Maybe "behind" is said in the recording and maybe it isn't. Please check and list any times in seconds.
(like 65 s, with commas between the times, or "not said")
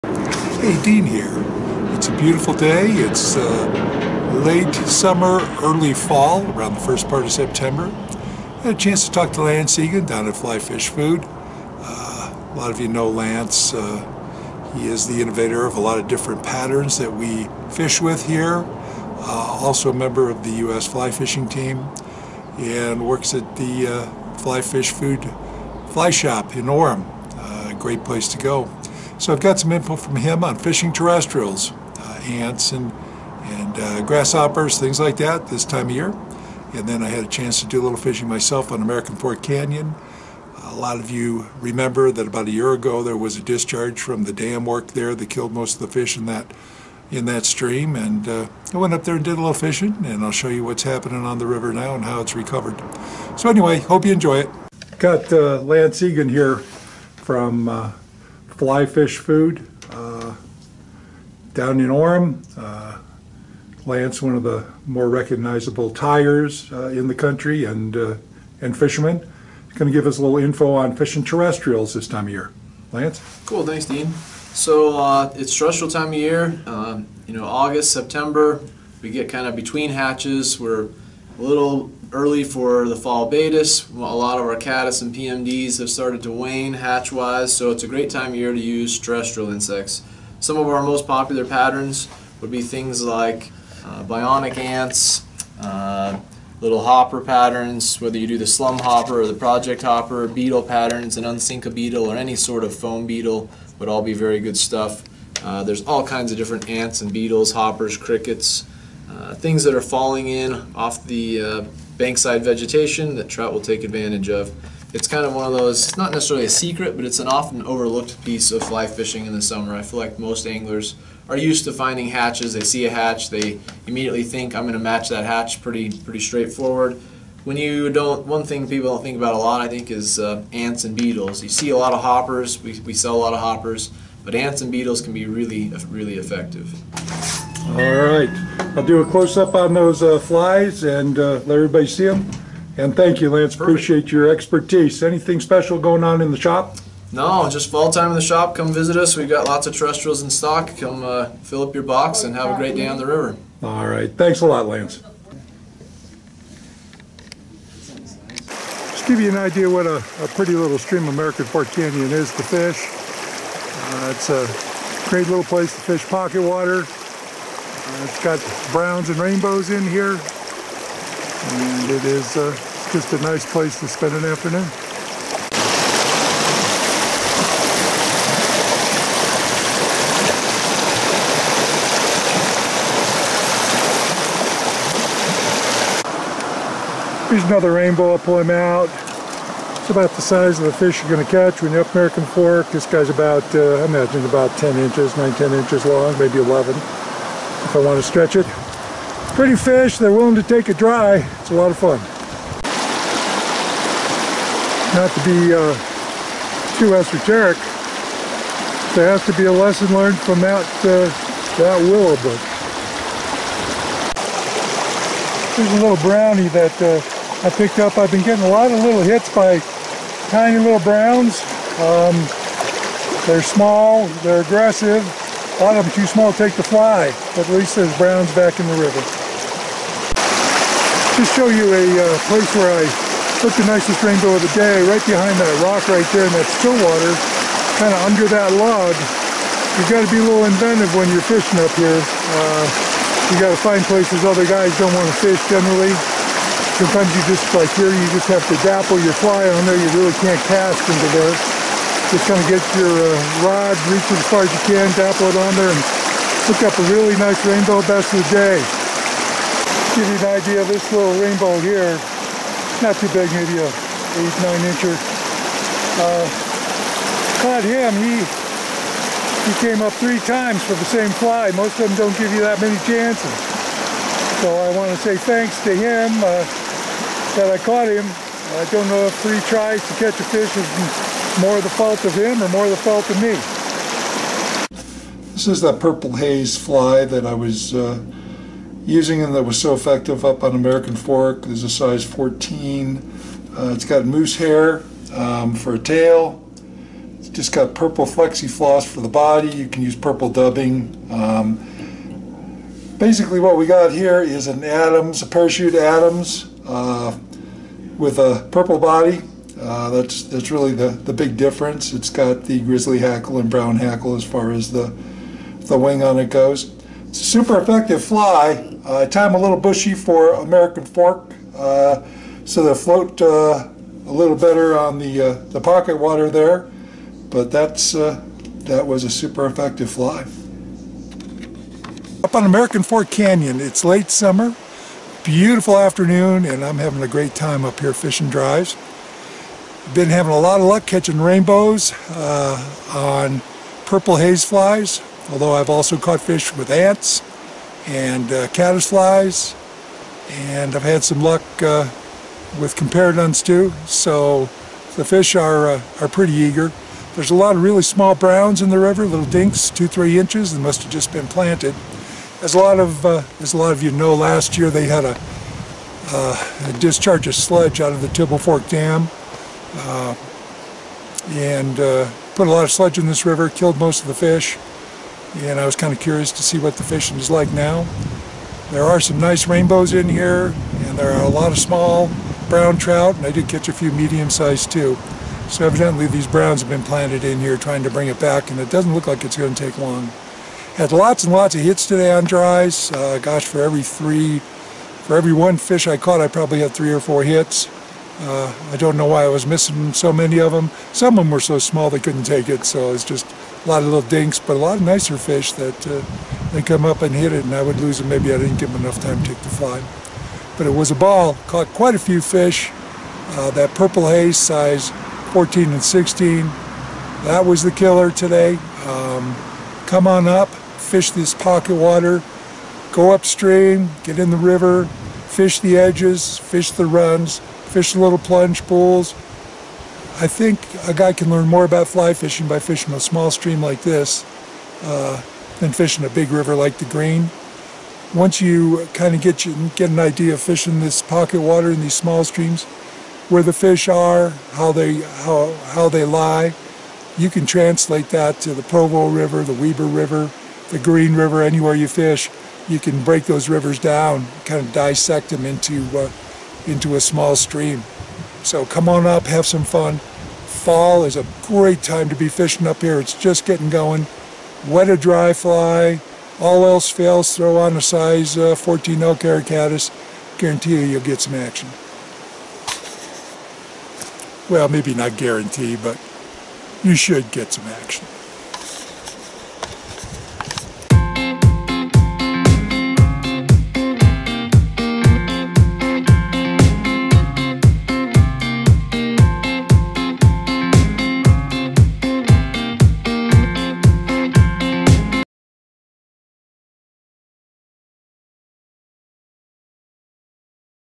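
235 s.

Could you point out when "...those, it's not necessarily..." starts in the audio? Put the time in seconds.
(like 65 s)
115 s.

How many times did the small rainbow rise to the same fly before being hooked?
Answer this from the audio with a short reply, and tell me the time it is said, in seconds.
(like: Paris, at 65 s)
3, at 269 s.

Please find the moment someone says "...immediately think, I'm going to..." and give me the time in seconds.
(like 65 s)
123 s.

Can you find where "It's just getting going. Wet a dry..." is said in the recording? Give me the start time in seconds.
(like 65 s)
462 s.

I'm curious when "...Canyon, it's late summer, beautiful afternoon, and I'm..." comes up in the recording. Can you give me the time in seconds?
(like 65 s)
333 s.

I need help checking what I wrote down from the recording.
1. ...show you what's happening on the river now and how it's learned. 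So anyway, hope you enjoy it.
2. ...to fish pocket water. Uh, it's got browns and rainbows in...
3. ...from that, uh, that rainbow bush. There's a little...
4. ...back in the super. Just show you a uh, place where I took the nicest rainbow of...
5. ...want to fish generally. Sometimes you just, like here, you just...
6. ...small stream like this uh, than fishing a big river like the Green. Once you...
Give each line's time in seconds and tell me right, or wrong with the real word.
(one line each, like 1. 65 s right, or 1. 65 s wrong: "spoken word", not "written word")
1. 50 s wrong: "recovered", not "learned"
2. 165 s right
3. 210 s wrong: "willow", not "rainbow"
4. 228 s wrong: "river", not "super"
5. 244 s right
6. 432 s right.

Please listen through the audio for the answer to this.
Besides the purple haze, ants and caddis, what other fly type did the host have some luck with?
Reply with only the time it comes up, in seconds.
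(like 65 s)
352 s.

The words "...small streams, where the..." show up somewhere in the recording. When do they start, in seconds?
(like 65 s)
441 s.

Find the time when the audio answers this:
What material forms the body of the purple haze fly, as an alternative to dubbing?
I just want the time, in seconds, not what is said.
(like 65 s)
297 s.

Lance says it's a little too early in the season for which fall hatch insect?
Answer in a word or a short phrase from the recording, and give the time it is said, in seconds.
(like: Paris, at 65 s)
Baetis, at 83 s.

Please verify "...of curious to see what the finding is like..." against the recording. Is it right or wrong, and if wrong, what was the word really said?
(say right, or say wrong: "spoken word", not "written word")
wrong: "fishing", not "finding".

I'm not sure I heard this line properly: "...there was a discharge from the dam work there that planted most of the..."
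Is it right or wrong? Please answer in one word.
wrong.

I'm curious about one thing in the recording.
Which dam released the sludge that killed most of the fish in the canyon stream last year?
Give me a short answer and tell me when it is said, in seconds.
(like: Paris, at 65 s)
Tibble Fork Dam, at 368 s.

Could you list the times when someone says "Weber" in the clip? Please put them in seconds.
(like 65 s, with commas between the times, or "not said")
449 s.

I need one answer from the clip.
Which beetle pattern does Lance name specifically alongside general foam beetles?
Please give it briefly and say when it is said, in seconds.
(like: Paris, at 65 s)
Unsinka beetle, at 101 s.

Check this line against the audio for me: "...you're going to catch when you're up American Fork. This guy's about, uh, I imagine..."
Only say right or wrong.
right.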